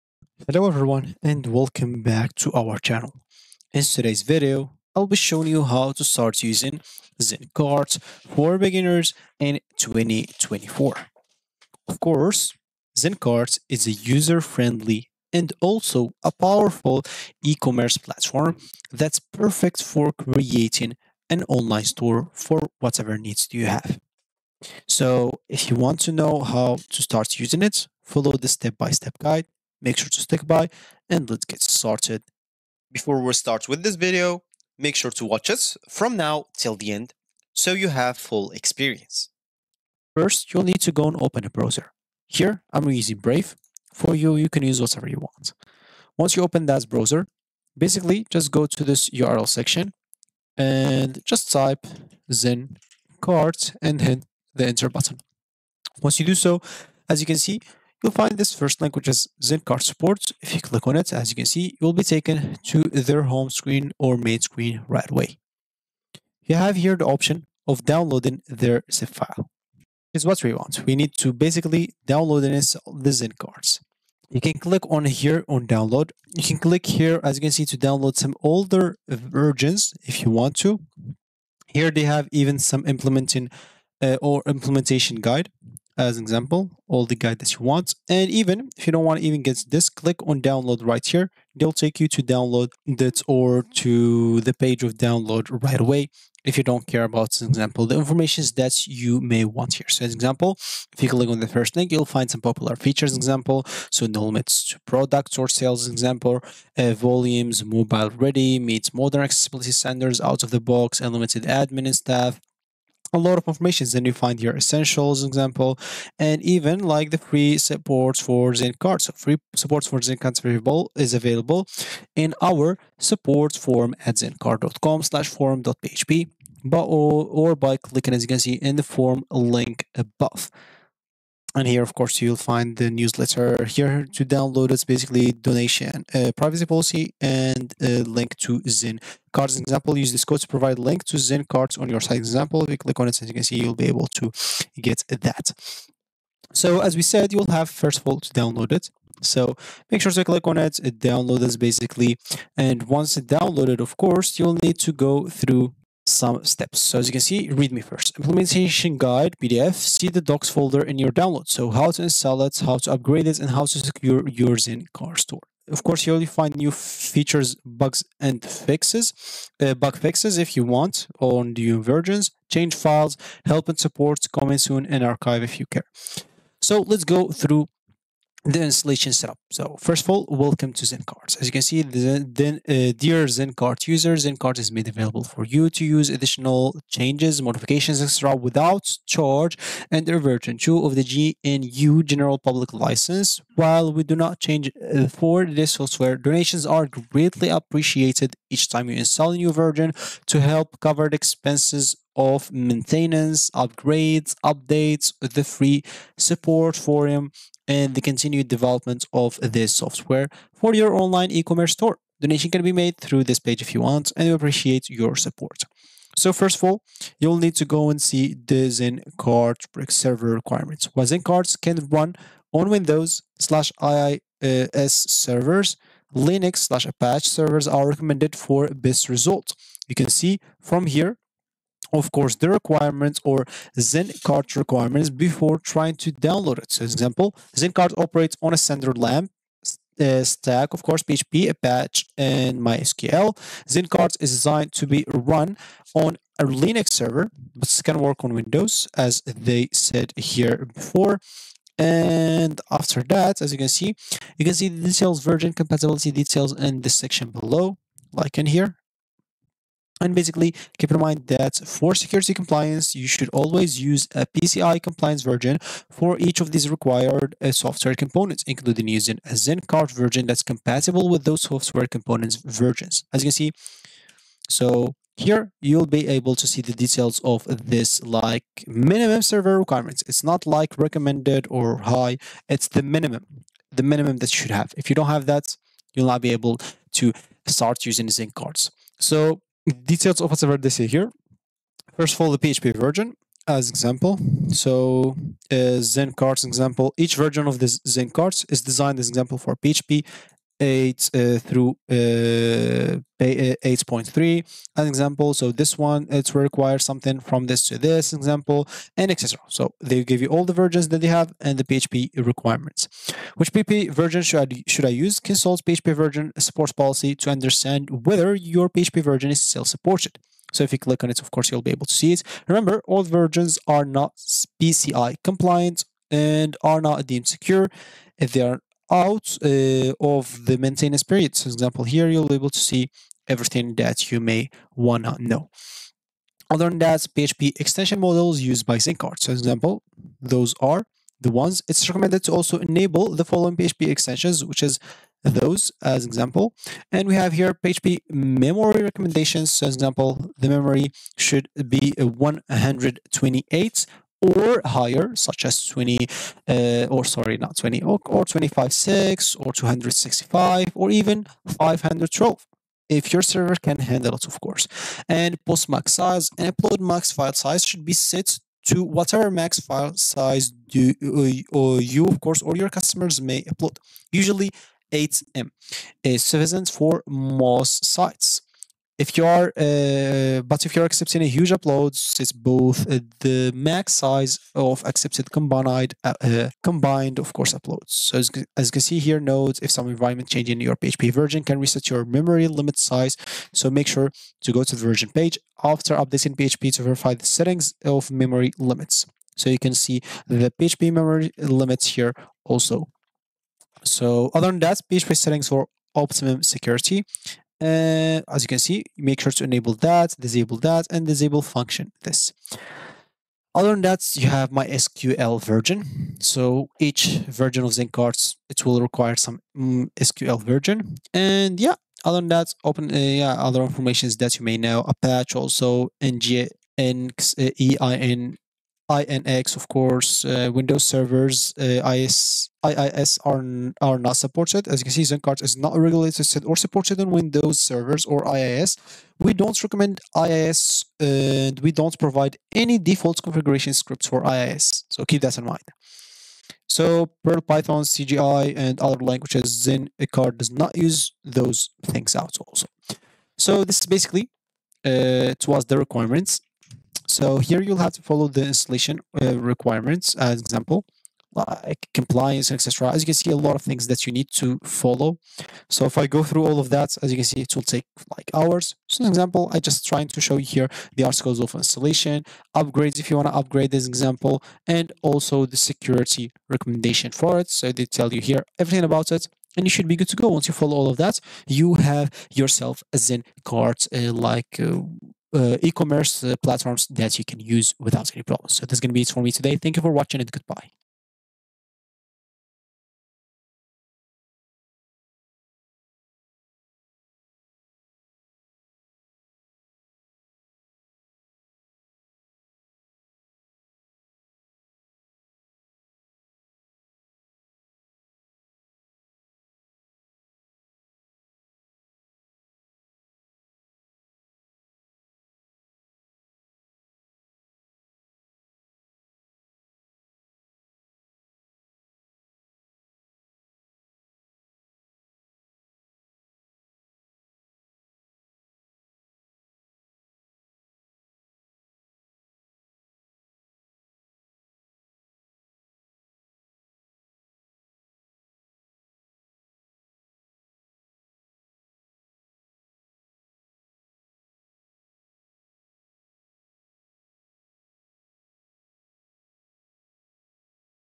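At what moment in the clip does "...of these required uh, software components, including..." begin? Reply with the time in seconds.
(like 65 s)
266 s.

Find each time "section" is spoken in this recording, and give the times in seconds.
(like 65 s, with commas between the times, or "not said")
49 s, 256 s.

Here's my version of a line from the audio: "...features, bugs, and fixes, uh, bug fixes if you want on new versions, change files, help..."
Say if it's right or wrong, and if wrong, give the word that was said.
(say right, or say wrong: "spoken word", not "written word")
right.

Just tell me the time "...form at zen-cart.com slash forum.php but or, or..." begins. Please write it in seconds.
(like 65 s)
123 s.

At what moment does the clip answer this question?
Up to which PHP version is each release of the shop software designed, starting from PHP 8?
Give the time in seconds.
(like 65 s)
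303 s.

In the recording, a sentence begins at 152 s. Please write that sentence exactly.
And once it downloaded, of course, you'll need to go through some steps.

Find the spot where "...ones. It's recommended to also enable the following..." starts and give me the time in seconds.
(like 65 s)
341 s.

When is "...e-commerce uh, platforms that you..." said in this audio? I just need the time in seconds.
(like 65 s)
485 s.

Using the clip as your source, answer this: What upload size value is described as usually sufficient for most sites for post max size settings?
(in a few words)
8M.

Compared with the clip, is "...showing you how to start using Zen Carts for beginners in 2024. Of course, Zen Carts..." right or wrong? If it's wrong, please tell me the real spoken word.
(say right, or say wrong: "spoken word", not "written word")
right.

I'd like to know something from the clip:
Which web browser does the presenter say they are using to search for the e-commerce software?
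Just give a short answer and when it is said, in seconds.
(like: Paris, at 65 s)
Brave, at 43 s.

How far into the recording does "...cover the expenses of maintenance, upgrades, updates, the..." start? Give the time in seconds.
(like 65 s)
200 s.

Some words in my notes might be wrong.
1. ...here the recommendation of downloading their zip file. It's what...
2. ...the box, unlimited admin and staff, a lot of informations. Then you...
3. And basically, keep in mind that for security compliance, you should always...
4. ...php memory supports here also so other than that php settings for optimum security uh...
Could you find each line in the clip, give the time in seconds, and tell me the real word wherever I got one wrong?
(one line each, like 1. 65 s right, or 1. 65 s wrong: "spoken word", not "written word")
1. 66 s wrong: "option", not "recommendation"
2. 110 s right
3. 260 s right
4. 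400 s wrong: "limits", not "supports".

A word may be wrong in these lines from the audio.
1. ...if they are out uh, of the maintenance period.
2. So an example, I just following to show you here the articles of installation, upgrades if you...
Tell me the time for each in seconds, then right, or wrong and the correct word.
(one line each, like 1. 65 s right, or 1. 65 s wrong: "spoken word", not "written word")
1. 328 s right
2. 468 s wrong: "trying", not "following".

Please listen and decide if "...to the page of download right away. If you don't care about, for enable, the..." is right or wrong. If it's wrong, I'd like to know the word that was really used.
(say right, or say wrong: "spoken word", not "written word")
wrong: "example", not "enable".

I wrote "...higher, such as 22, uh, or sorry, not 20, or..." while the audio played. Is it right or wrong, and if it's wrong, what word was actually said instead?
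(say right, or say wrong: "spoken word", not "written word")
wrong: "20", not "22".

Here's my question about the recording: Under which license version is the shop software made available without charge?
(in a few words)
version 2 of the GNU General Public License.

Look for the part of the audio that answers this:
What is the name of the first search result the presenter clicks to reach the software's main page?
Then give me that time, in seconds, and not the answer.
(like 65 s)
59 s.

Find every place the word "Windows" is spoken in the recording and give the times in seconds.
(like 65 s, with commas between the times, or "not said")
222 s, 248 s, 430 s, 437 s.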